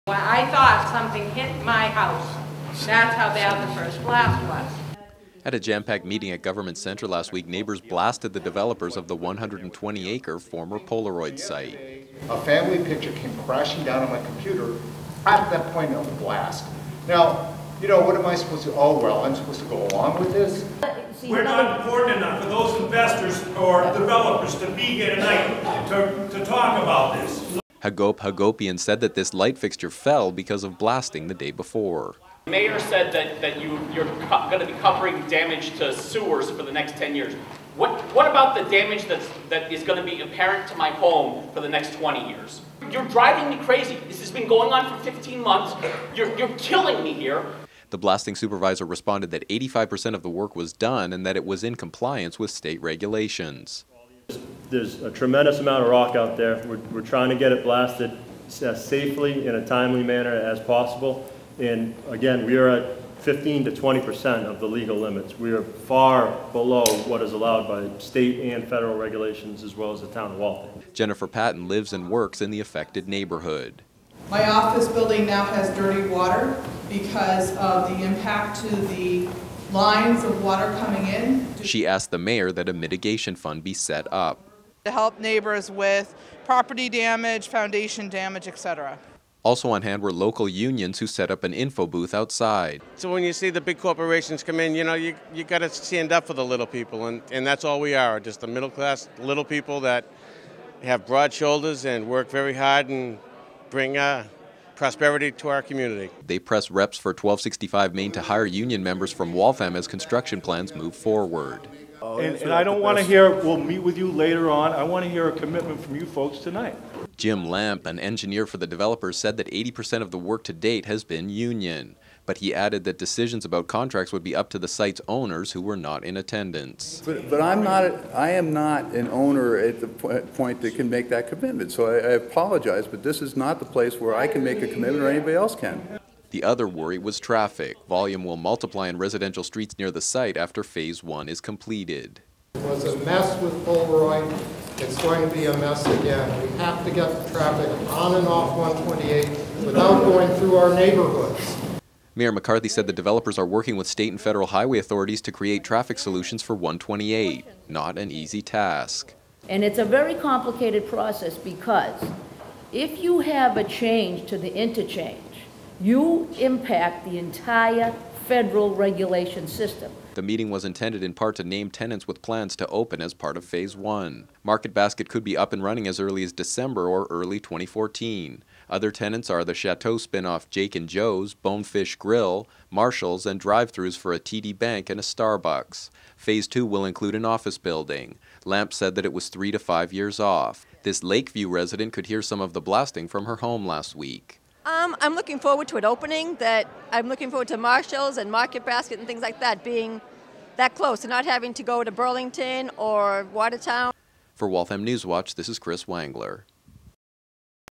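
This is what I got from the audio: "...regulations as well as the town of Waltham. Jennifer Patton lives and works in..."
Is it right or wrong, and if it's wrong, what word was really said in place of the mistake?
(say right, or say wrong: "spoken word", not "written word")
right.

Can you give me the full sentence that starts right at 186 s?
Phase 2 will include an office building.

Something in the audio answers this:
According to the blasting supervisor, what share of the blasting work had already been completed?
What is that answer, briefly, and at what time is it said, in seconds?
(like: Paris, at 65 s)
85%, at 49 s.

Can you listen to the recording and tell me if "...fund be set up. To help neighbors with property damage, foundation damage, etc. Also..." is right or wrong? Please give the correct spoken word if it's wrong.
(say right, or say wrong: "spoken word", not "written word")
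right.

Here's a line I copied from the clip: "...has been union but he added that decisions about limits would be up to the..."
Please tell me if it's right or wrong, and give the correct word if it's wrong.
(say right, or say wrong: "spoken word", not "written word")
wrong: "contracts", not "limits".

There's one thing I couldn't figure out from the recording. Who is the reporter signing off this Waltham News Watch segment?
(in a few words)
Chris Wangler.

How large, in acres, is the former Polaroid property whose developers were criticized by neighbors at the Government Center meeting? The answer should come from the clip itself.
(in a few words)
120.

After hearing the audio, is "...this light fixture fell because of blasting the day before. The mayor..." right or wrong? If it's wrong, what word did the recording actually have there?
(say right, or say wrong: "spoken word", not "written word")
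right.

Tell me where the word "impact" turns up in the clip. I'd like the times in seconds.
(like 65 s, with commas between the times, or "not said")
78 s, 166 s.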